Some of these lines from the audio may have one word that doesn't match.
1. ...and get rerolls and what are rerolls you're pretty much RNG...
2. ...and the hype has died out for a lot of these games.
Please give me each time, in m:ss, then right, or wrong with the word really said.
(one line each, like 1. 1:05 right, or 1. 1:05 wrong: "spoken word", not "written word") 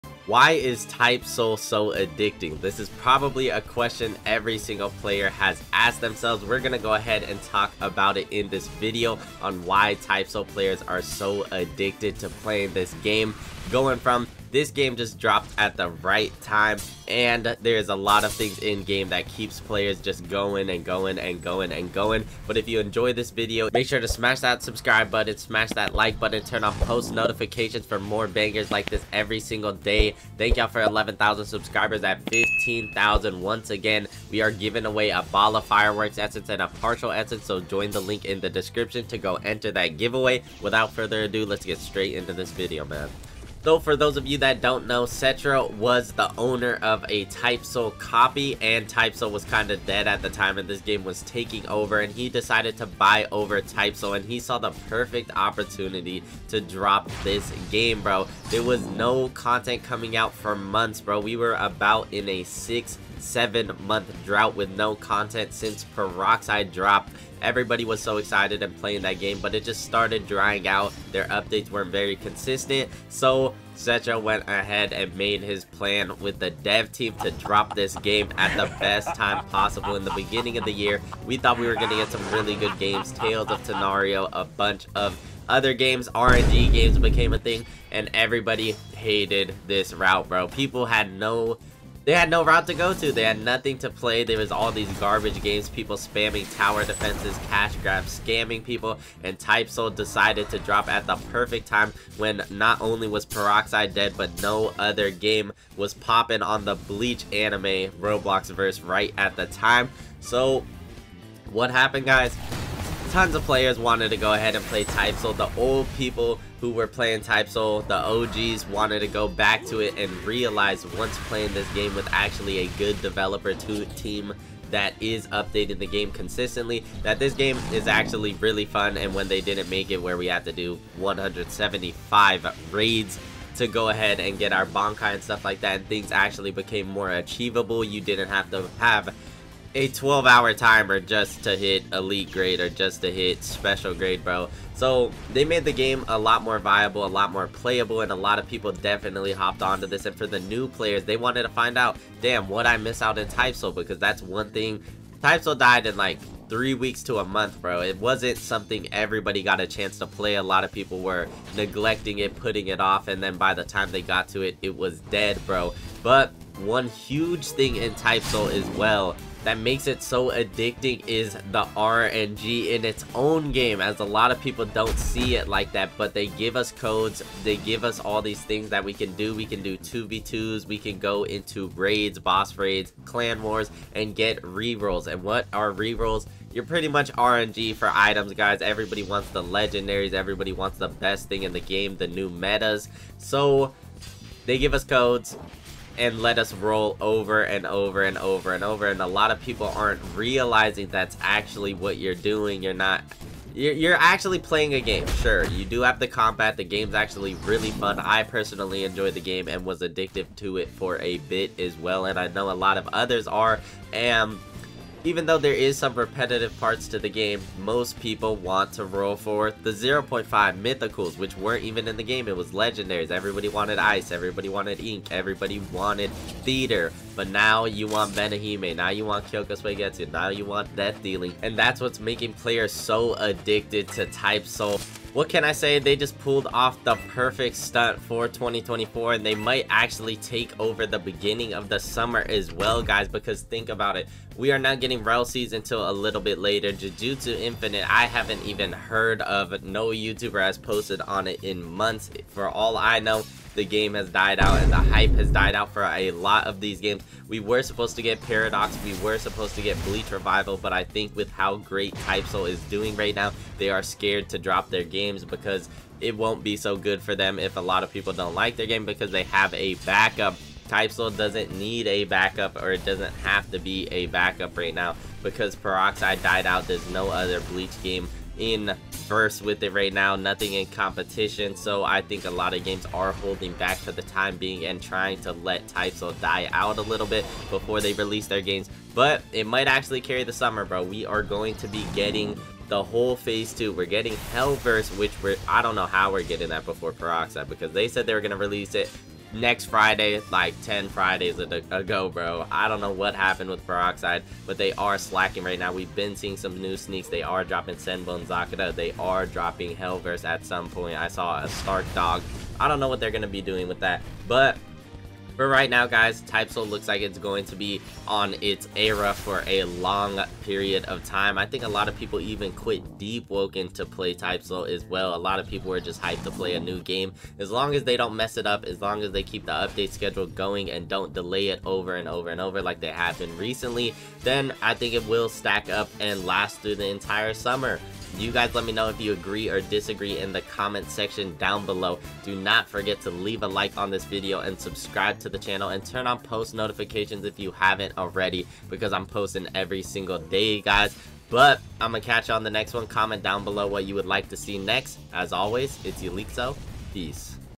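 1. 3:03 right
2. 4:14 right.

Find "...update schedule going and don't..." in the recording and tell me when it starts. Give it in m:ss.
5:29.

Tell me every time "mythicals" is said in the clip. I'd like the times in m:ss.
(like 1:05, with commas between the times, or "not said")
3:40.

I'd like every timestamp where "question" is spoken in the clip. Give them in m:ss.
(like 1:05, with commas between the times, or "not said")
0:03.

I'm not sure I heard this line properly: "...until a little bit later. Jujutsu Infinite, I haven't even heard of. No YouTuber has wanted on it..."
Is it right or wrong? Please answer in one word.
wrong.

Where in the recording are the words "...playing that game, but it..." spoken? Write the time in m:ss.
1:08.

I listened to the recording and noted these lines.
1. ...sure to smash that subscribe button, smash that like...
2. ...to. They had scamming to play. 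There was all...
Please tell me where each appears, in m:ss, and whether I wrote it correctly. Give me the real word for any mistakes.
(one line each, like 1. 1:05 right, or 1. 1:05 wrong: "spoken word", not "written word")
1. 0:23 right
2. 1:32 wrong: "nothing", not "scamming".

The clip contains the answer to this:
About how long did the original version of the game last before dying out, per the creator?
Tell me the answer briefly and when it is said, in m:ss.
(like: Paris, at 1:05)
three weeks to a month, at 2:36.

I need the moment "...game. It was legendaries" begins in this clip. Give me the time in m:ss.
3:42.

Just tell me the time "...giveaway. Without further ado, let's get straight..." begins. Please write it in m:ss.
0:39.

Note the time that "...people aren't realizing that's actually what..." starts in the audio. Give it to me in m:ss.
3:19.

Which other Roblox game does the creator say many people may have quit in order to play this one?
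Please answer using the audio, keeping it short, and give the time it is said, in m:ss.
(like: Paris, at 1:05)
Deepwoken, at 5:22.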